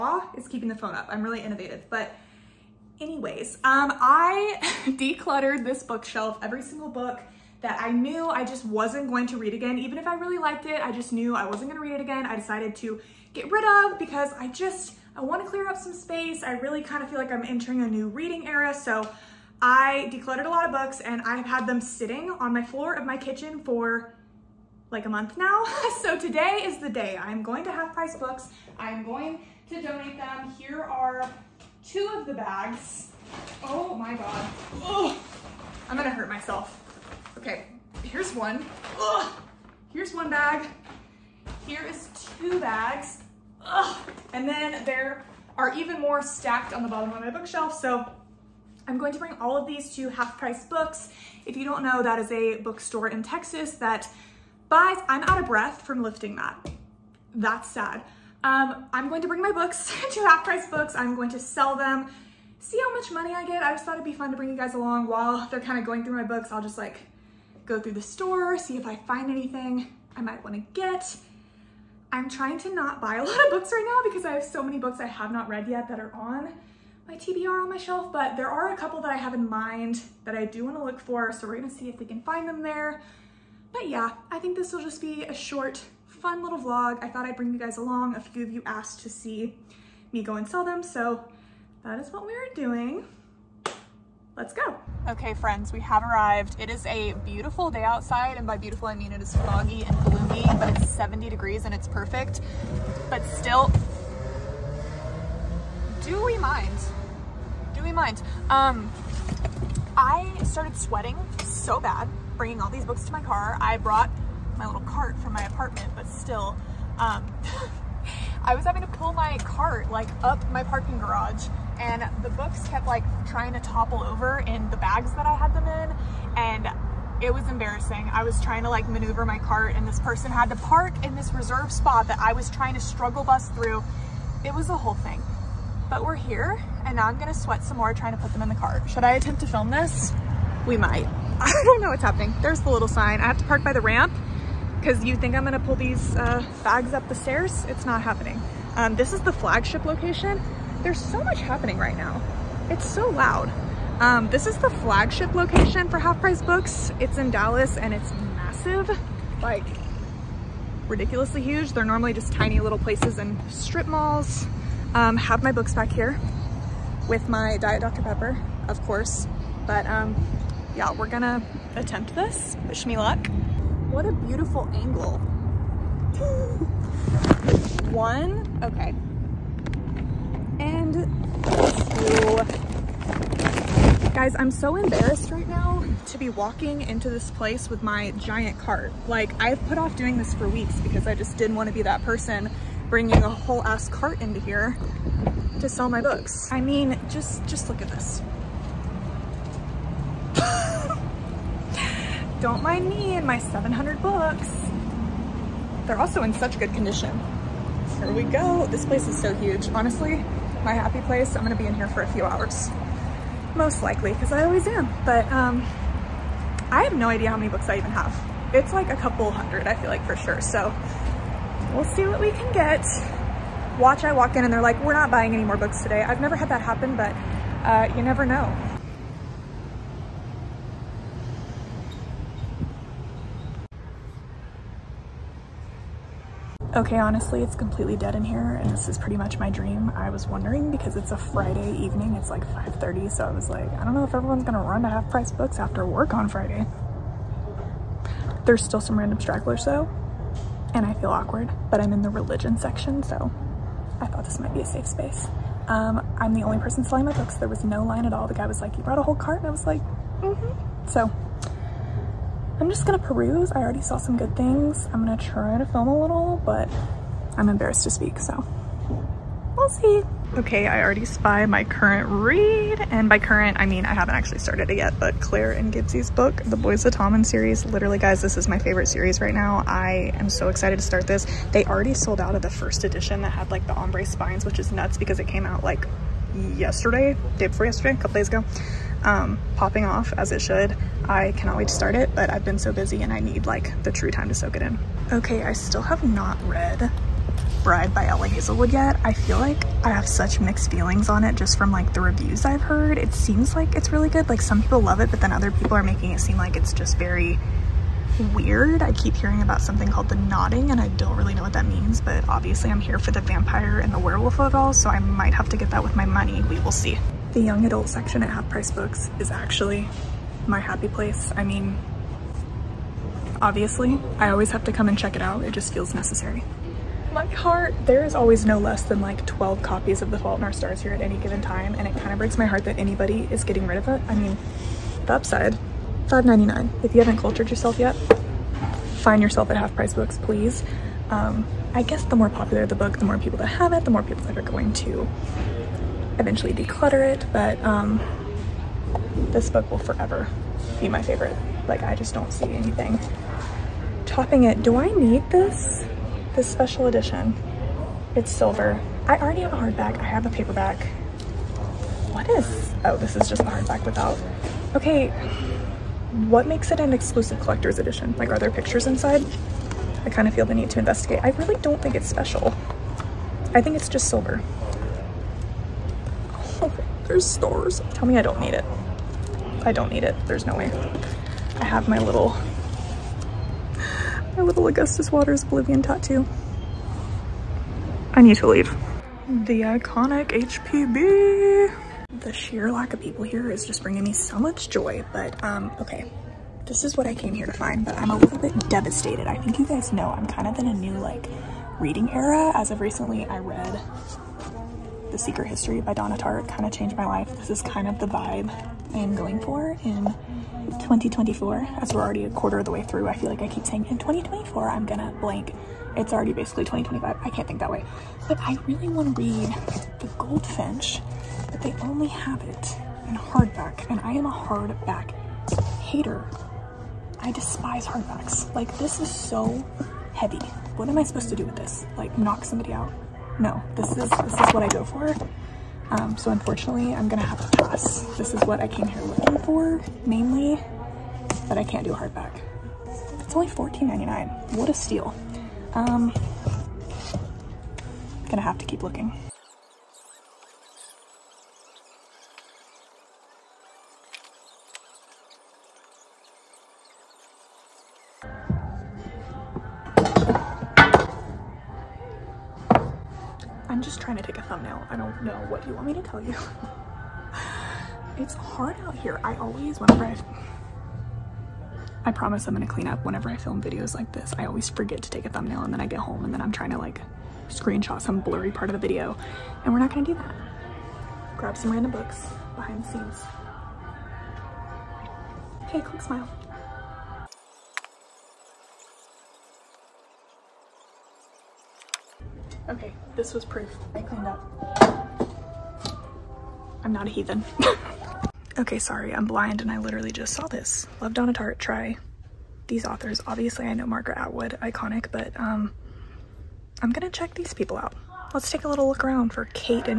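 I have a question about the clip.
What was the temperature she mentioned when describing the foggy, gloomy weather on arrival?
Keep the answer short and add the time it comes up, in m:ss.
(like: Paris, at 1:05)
70 degrees, at 1:40.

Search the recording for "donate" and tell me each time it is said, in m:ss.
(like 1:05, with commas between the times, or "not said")
0:29.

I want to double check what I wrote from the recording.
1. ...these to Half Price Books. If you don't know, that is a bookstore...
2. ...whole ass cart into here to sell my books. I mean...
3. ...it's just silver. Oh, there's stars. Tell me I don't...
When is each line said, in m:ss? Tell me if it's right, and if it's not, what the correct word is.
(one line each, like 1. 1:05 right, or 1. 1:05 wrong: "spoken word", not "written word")
1. 0:49 right
2. 3:13 right
3. 6:13 right.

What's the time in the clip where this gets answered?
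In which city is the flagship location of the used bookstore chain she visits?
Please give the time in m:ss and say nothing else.
2:37.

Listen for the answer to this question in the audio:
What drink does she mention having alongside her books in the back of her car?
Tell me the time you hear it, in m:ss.
2:47.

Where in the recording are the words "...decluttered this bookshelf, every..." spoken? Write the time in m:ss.
0:04.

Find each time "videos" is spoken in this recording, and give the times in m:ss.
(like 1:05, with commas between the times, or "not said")
7:53, 7:58.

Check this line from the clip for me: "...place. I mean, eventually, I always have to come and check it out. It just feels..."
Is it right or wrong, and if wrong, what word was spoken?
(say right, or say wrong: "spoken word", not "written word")
wrong: "obviously", not "eventually".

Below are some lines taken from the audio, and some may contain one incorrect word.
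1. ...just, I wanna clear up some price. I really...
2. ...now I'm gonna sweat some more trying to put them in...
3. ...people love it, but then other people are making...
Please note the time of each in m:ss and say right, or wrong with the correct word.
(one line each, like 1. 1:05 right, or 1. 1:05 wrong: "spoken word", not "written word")
1. 0:14 wrong: "space", not "price"
2. 2:16 right
3. 5:04 right.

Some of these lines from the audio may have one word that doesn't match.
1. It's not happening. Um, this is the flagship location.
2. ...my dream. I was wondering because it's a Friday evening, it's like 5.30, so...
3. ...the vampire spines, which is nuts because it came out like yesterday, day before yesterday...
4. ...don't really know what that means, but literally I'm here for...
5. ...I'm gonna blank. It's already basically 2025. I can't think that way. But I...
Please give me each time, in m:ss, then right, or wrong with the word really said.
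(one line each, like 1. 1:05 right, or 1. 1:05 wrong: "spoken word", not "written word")
1. 2:27 right
2. 3:59 right
3. 4:43 wrong: "ombre", not "vampire"
4. 5:10 wrong: "obviously", not "literally"
5. 6:54 right.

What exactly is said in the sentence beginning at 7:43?
just trying to take a thumbnail.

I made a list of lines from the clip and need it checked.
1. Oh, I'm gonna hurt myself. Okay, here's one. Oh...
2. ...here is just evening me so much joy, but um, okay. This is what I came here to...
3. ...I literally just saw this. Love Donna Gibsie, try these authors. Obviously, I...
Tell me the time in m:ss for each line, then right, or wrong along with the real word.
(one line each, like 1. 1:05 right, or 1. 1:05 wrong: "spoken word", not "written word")
1. 0:34 right
2. 6:33 wrong: "bringing", not "evening"
3. 8:19 wrong: "Tartt", not "Gibsie".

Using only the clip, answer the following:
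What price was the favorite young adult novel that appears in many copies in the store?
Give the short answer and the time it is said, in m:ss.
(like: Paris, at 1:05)
$5.99, at 5:36.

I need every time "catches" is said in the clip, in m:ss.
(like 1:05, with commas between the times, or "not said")
not said.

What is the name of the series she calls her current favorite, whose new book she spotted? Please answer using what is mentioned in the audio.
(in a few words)
The Boys of Tommen.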